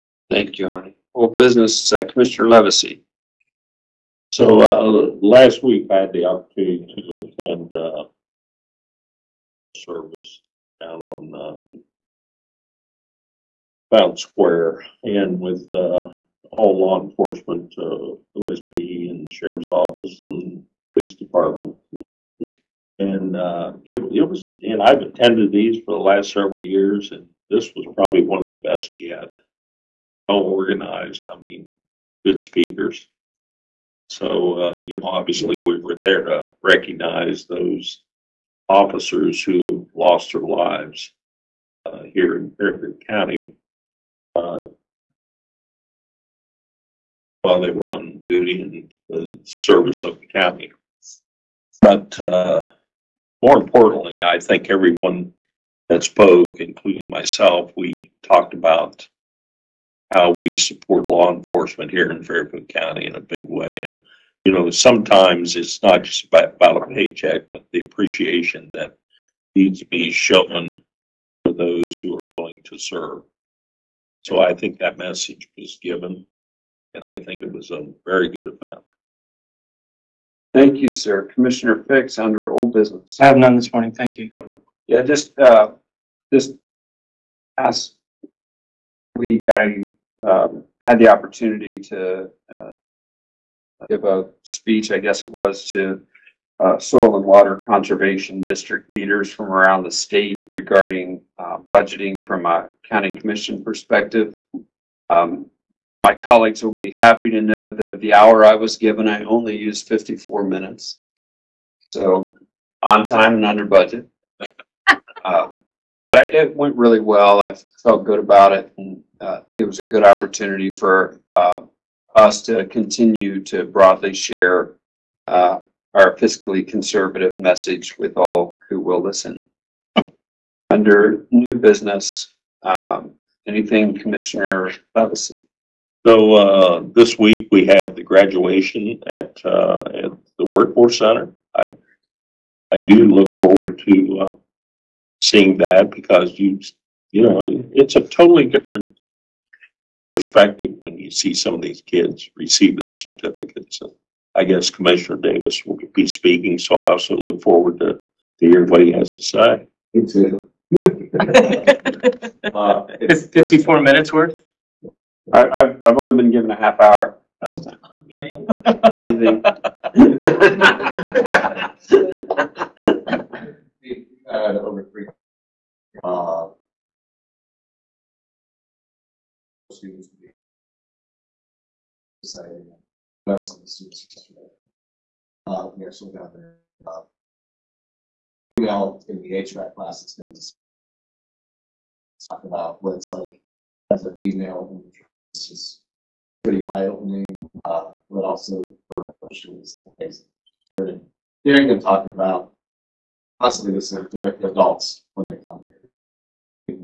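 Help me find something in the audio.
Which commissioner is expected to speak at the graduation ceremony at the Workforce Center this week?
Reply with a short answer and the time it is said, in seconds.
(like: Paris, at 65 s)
Commissioner Davis, at 154 s.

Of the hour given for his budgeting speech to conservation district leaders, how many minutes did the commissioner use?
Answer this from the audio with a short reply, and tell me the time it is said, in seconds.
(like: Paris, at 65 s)
54, at 109 s.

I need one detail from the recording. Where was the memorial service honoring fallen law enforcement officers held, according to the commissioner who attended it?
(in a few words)
Fountain Square.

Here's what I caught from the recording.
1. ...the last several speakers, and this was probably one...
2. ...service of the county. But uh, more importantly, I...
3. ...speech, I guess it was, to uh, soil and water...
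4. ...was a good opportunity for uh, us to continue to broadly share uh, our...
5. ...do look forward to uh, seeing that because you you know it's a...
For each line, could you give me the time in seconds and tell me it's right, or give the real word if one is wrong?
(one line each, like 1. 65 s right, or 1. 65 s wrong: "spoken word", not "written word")
1. 25 s wrong: "years", not "speakers"
2. 49 s right
3. 94 s right
4. 119 s right
5. 142 s right.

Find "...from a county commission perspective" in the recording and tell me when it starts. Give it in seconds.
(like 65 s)
102 s.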